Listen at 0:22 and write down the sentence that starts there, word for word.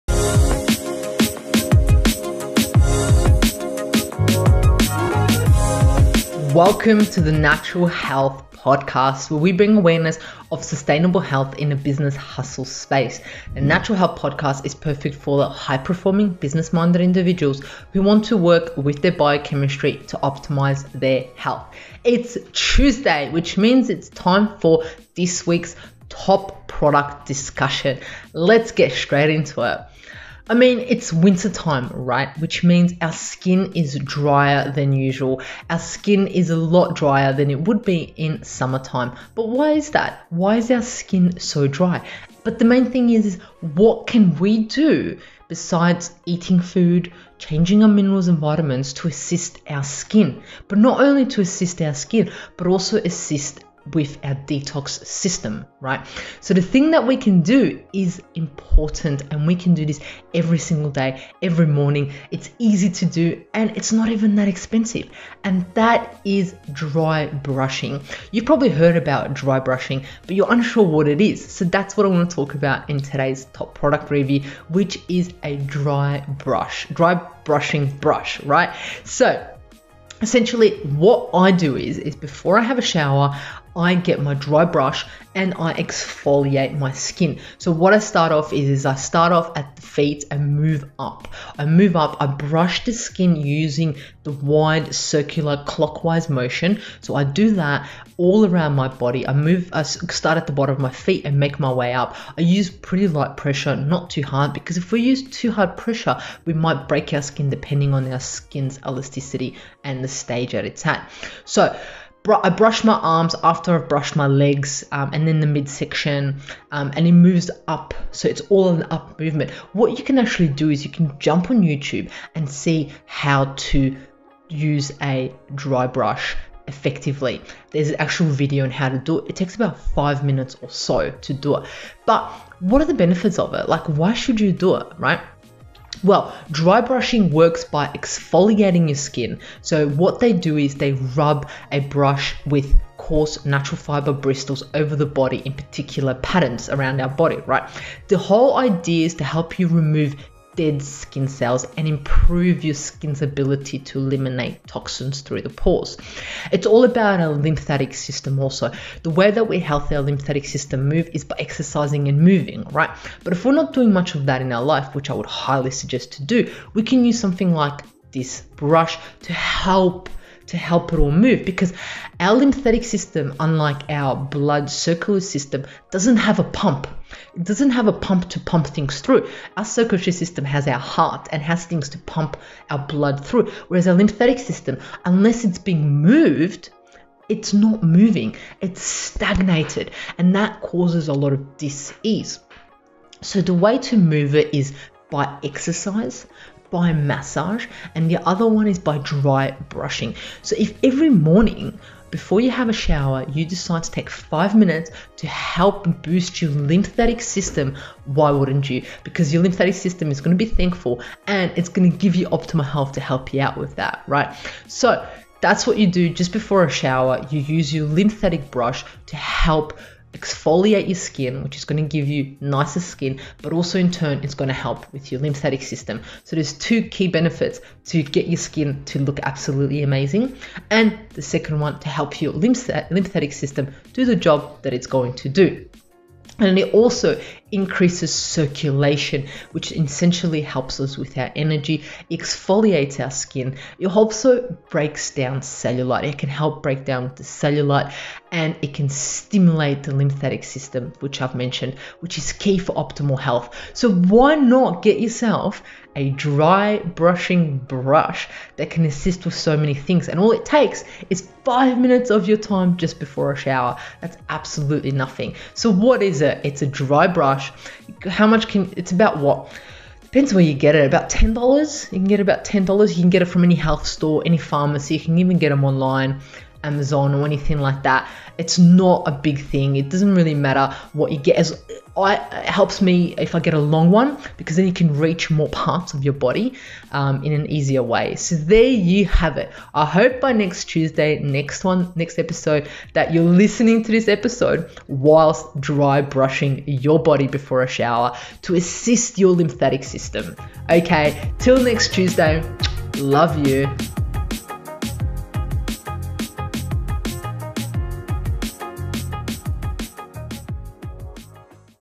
It's Tuesday, which means it's time for this week's top product discussion.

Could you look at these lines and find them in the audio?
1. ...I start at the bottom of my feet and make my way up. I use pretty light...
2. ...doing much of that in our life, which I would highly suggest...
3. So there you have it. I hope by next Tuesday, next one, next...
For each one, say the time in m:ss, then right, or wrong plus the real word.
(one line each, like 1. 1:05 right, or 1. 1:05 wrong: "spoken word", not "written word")
1. 1:39 right
2. 2:43 right
3. 4:48 right.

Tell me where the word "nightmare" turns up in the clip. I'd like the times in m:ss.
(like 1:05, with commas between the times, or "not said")
not said.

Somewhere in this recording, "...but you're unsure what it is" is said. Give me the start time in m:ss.
1:10.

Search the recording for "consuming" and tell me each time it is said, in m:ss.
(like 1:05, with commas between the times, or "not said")
not said.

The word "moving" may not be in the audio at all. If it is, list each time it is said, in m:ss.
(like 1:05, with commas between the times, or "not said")
2:42, 3:07.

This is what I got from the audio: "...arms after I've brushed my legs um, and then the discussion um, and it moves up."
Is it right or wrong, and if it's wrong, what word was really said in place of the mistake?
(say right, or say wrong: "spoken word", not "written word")
wrong: "midsection", not "discussion".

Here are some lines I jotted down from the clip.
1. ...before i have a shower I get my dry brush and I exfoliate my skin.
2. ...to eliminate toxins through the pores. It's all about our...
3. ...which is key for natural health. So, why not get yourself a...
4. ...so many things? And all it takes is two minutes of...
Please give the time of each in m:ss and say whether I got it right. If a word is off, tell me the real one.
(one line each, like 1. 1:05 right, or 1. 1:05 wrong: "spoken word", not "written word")
1. 1:22 right
2. 2:33 right
3. 4:11 wrong: "optimal", not "natural"
4. 4:19 wrong: "five", not "two".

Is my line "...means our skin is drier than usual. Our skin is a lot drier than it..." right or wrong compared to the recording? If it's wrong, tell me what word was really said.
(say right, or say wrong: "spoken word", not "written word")
right.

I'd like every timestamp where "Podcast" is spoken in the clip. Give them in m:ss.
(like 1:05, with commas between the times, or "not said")
0:08, 0:14.